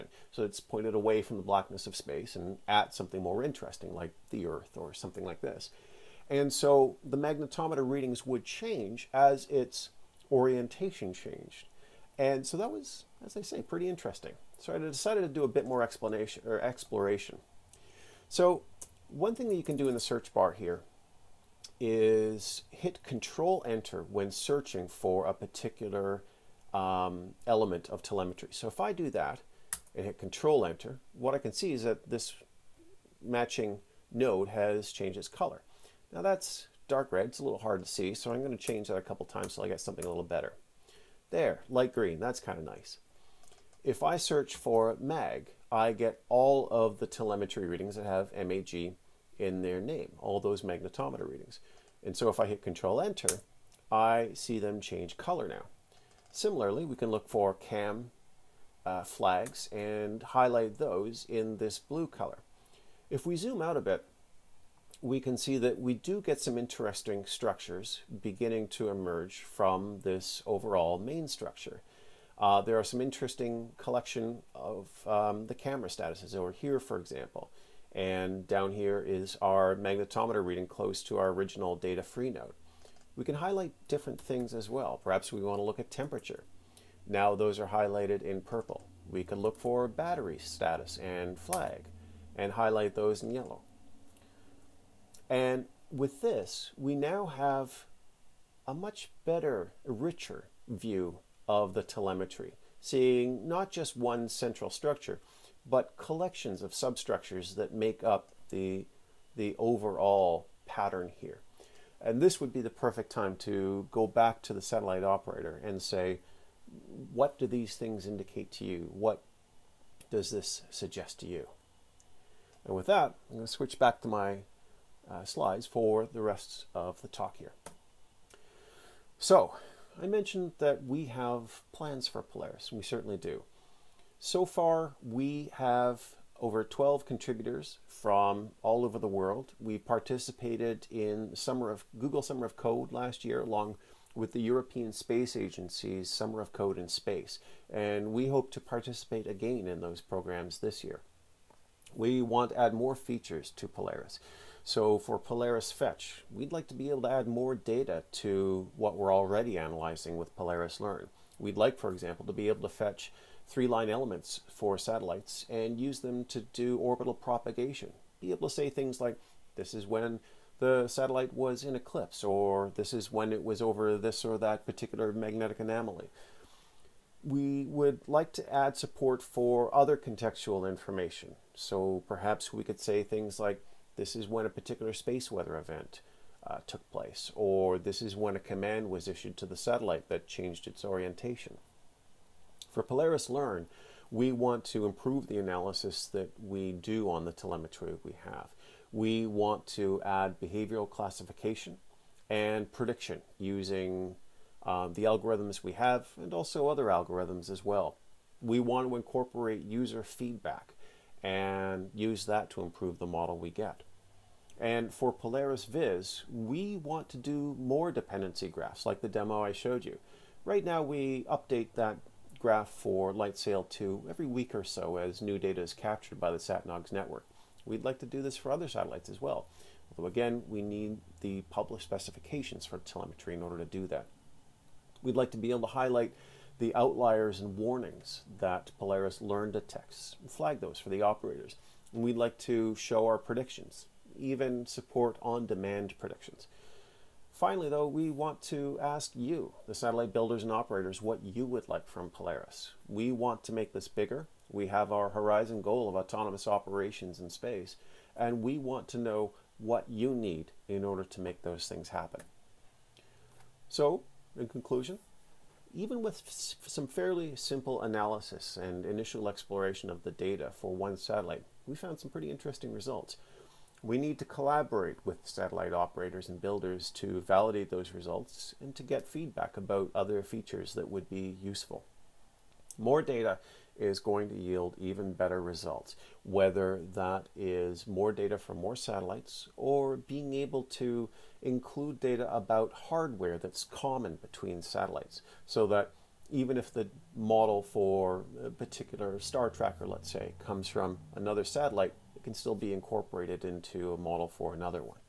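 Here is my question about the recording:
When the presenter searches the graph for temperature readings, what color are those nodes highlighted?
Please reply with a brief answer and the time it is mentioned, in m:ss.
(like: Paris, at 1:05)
Purple, at 1:28.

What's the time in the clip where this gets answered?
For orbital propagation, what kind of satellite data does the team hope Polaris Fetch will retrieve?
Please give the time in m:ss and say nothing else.
2:43.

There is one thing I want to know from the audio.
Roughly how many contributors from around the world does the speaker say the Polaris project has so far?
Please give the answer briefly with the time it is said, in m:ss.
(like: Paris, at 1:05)
Over 12, at 2:16.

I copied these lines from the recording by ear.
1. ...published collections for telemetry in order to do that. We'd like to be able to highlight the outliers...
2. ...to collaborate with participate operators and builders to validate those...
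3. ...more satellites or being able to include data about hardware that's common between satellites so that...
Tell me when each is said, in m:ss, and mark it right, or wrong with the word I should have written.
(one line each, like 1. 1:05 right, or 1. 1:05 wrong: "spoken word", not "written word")
1. 3:51 wrong: "specifications", not "collections"
2. 4:34 wrong: "satellite", not "participate"
3. 4:48 right.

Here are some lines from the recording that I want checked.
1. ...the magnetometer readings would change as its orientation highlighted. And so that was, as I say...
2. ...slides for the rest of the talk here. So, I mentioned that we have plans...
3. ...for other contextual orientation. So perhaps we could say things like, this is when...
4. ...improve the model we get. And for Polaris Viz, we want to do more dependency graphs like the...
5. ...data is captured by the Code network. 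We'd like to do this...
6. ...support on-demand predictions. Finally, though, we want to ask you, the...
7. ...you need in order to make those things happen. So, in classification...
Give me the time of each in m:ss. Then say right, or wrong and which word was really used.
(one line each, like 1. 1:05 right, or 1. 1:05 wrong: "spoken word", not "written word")
1. 0:07 wrong: "changed", not "highlighted"
2. 2:05 right
3. 2:59 wrong: "information", not "orientation"
4. 3:32 right
5. 3:45 wrong: "SatNogs", not "Code"
6. 4:04 right
7. 4:19 wrong: "conclusion", not "classification".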